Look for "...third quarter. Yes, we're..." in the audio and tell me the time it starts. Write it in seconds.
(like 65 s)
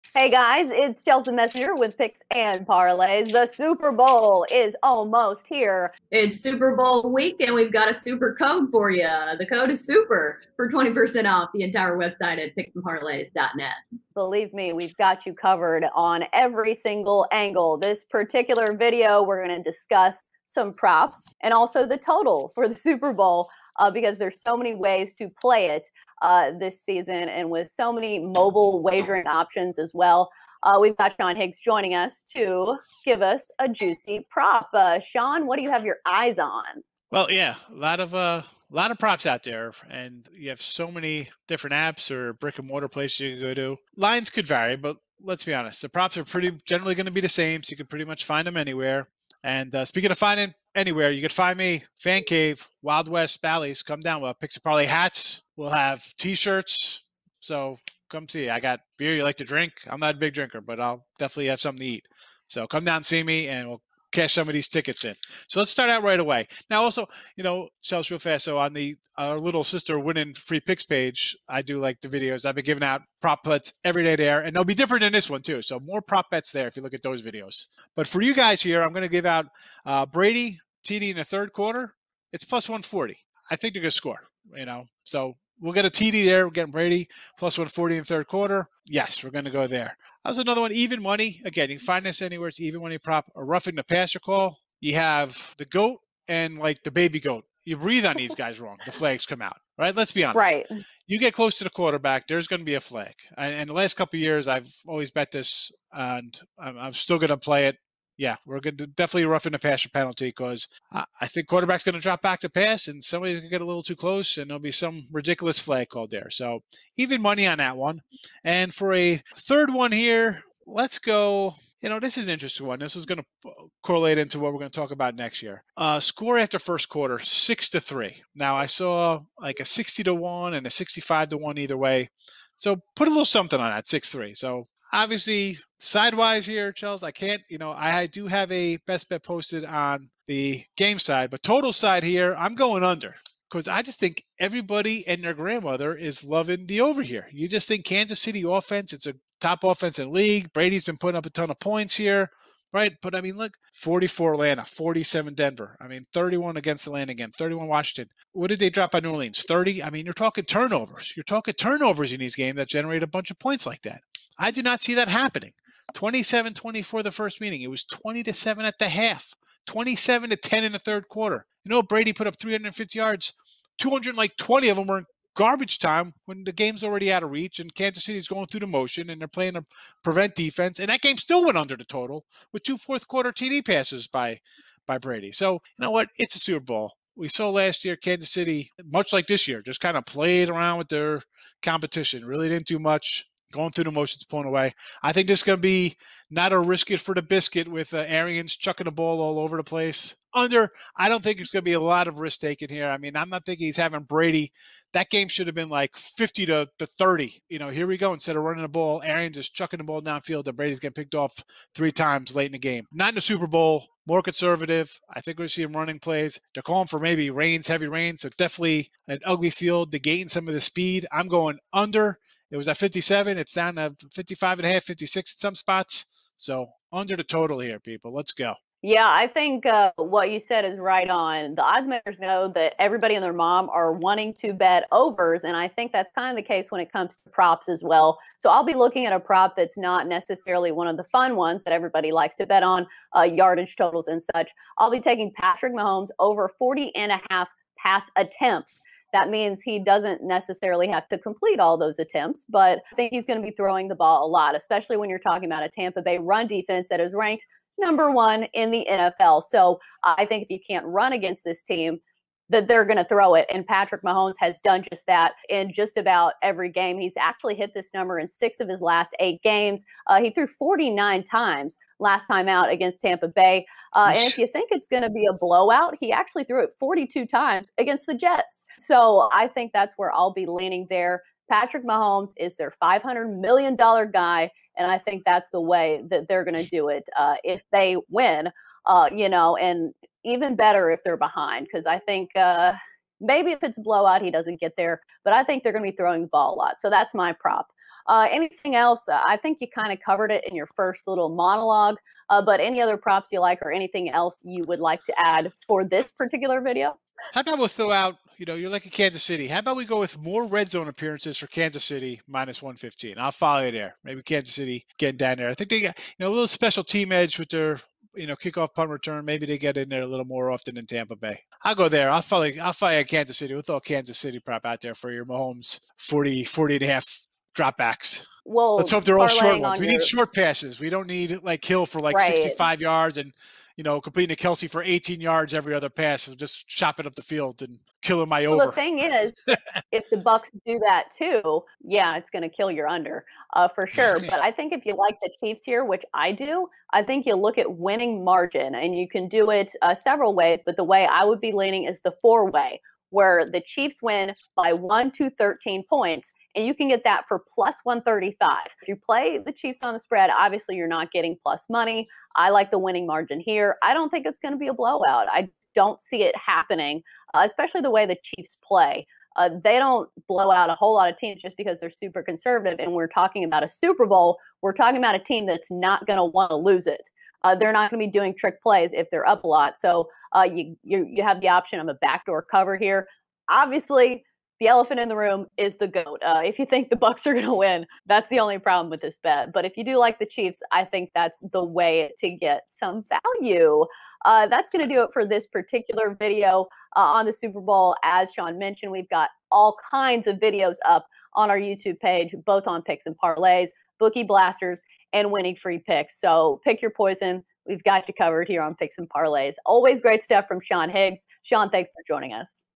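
88 s.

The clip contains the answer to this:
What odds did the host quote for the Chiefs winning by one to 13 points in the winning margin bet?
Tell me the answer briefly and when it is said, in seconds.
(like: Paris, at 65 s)
+135, at 357 s.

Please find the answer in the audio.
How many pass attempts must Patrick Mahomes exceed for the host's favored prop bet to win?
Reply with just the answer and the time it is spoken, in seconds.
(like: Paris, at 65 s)
40.5, at 246 s.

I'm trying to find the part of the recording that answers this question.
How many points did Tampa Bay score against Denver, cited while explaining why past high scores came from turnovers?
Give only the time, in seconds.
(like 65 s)
154 s.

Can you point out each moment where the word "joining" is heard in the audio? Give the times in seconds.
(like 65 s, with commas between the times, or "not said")
31 s, 412 s.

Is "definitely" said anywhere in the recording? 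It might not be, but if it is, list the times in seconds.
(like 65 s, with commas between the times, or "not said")
61 s, 108 s, 218 s.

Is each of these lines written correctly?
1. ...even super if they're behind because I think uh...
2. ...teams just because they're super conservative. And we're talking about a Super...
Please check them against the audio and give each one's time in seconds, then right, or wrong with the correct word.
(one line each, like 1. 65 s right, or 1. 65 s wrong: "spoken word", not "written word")
1. 290 s wrong: "better", not "super"
2. 371 s right.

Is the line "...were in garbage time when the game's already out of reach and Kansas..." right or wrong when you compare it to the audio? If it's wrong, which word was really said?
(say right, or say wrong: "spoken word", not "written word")
right.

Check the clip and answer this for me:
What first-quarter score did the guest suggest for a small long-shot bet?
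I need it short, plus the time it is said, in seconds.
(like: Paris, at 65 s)
6 to 3, at 127 s.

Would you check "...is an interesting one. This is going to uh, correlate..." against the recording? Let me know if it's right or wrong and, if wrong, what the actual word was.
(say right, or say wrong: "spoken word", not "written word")
right.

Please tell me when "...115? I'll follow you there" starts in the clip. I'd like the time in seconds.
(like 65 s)
312 s.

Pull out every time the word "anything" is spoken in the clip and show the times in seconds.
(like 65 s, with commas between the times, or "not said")
298 s, 303 s.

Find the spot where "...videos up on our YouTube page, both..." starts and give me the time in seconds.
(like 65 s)
400 s.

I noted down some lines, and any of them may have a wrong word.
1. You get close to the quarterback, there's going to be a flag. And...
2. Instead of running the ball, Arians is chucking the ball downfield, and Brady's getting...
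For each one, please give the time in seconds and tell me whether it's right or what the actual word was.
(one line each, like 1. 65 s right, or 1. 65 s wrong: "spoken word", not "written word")
1. 101 s right
2. 208 s right.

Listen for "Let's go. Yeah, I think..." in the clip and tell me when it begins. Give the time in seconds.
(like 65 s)
228 s.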